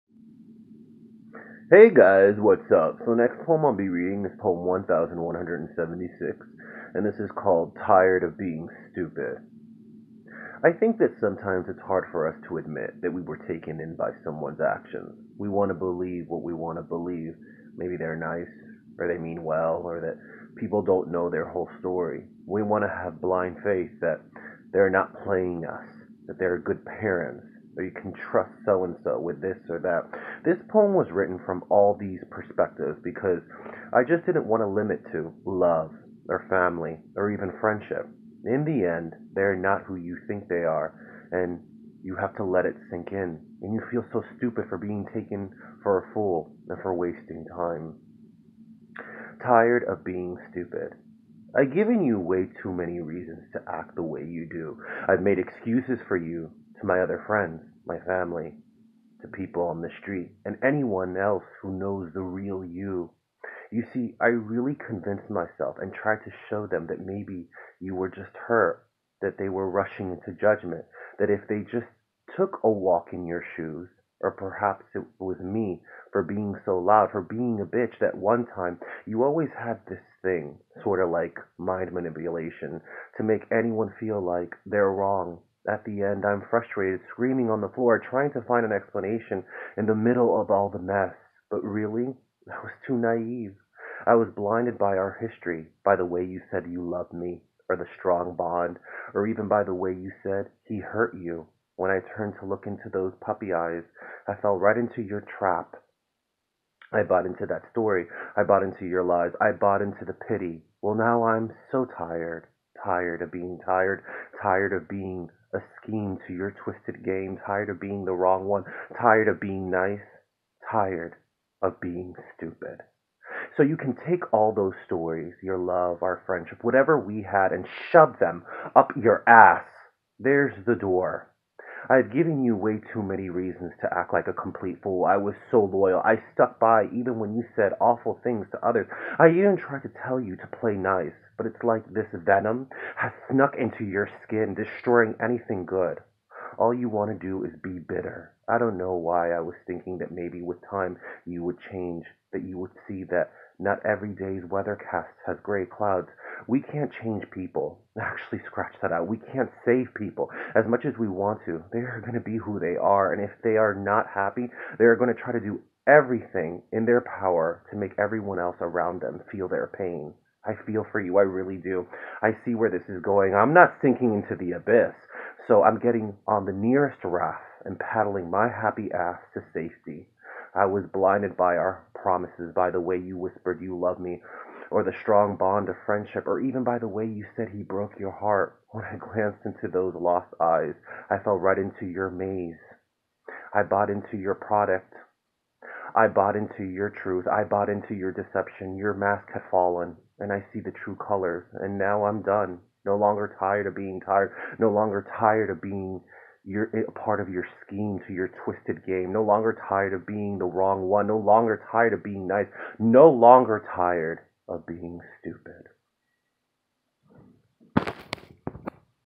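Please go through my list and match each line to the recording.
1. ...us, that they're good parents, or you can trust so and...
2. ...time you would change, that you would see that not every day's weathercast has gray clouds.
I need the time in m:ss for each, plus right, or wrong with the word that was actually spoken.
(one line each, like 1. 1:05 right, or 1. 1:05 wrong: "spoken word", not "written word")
1. 0:25 right
2. 2:30 right.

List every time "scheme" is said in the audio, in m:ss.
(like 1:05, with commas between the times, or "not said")
1:55, 3:27.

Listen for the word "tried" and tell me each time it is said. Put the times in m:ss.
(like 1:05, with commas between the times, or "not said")
1:05, 2:19.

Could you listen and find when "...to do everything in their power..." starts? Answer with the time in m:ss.
2:45.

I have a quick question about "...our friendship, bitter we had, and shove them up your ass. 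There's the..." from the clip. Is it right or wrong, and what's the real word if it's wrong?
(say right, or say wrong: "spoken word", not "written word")
wrong: "whatever", not "bitter".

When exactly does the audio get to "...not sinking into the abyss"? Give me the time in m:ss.
2:53.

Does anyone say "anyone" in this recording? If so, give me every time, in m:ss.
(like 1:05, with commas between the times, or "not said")
1:00, 1:23.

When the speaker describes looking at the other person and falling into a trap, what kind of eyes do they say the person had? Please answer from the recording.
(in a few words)
Puppy eyes.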